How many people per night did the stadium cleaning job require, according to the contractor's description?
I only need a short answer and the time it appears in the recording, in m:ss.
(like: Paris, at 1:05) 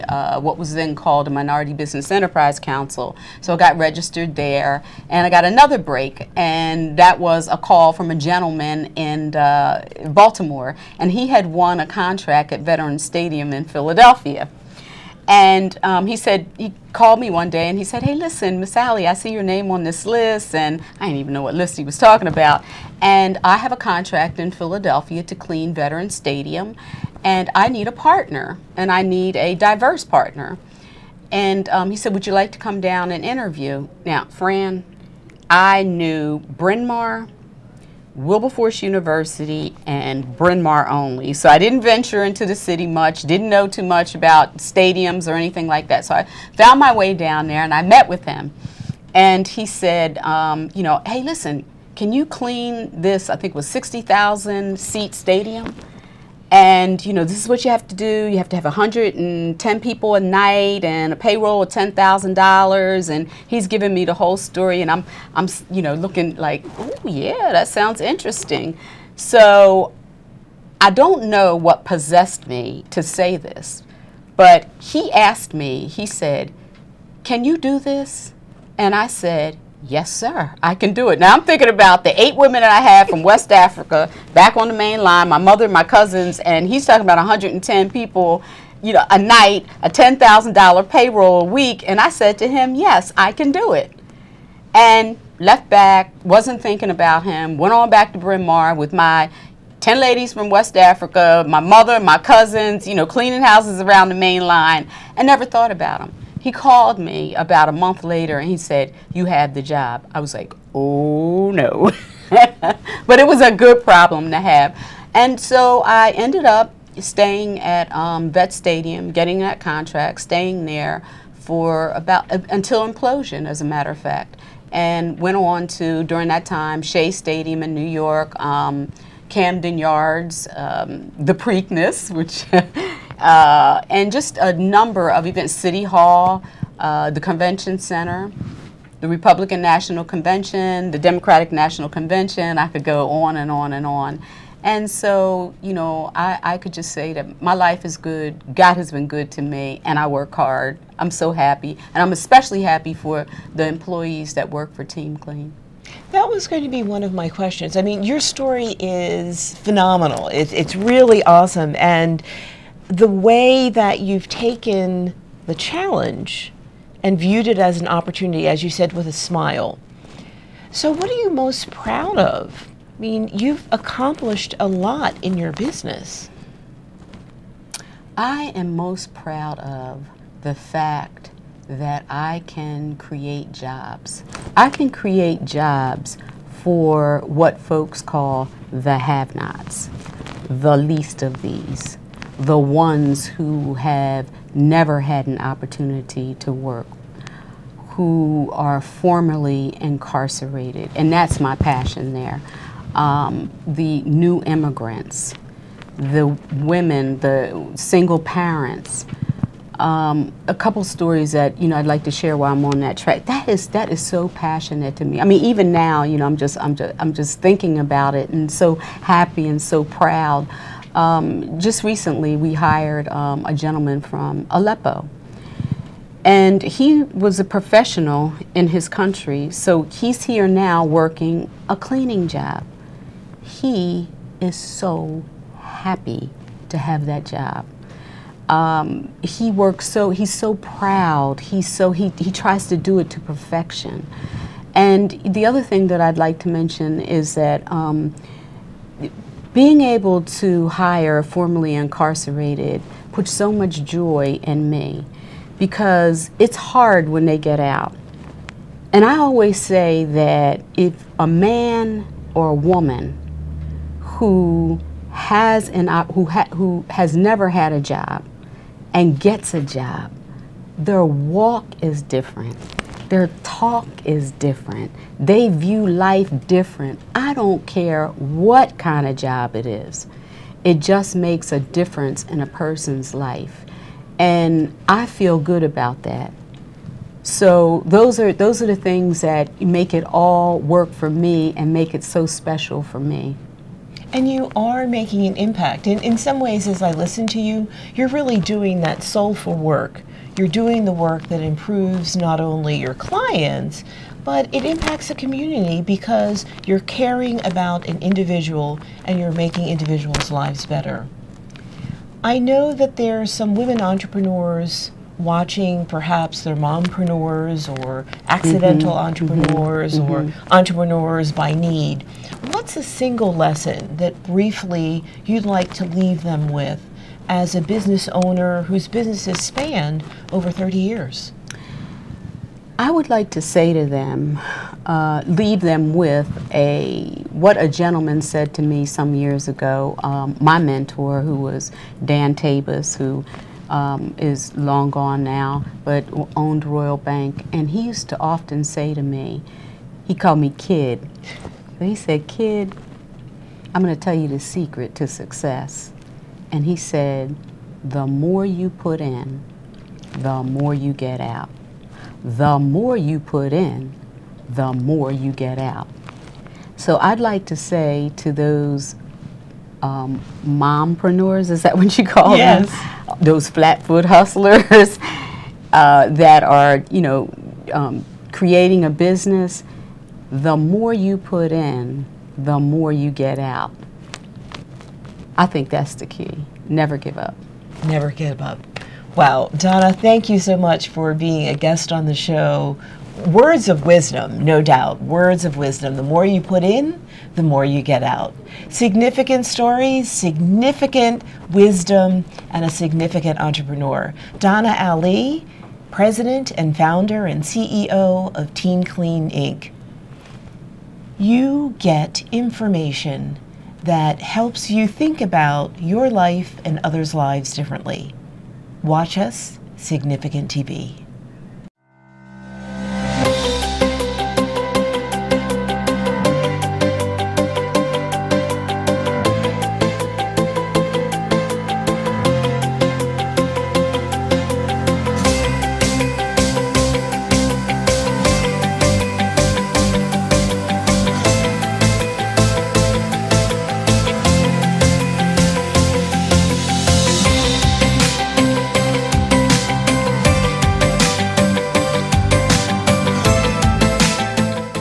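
110, at 0:58.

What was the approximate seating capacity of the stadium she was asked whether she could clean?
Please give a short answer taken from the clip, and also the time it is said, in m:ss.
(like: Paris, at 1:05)
60,000, at 0:53.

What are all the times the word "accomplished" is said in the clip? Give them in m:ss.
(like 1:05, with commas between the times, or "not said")
2:53.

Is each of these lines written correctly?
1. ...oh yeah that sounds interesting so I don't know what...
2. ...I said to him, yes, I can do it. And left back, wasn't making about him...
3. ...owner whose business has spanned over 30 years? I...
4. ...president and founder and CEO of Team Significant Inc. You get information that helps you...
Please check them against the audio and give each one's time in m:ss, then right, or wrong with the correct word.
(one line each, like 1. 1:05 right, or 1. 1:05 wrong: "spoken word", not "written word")
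1. 1:06 right
2. 1:31 wrong: "thinking", not "making"
3. 5:28 right
4. 6:45 wrong: "Clean", not "Significant".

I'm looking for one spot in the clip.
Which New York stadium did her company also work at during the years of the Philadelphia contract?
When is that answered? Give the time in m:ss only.
2:06.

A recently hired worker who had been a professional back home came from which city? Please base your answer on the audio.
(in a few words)
Aleppo.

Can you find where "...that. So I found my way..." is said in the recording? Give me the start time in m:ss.
0:45.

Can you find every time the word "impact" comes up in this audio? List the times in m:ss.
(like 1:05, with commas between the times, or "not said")
4:55, 5:04.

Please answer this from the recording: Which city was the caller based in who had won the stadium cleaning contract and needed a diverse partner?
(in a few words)
Baltimore.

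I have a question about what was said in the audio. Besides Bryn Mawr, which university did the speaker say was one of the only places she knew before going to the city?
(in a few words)
Wilberforce University.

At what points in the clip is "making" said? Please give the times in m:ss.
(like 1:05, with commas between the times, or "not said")
4:54, 5:09.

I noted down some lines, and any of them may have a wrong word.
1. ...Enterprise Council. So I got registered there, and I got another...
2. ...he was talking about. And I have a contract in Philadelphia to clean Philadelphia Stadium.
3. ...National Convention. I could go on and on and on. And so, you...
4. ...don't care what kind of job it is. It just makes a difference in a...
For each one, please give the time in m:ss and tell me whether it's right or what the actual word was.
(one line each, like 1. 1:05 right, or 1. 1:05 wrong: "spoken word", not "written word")
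1. 0:02 right
2. 0:21 wrong: "Veteran", not "Philadelphia"
3. 2:21 right
4. 4:37 right.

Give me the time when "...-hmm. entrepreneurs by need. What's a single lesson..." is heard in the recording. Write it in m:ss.
5:20.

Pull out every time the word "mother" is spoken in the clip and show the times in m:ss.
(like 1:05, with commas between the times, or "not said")
1:25, 1:41.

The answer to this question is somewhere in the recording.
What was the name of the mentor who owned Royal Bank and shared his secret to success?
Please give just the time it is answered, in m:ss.
5:42.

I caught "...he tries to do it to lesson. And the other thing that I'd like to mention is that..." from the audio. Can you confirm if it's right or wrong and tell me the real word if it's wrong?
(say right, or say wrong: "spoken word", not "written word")
wrong: "perfection", not "lesson".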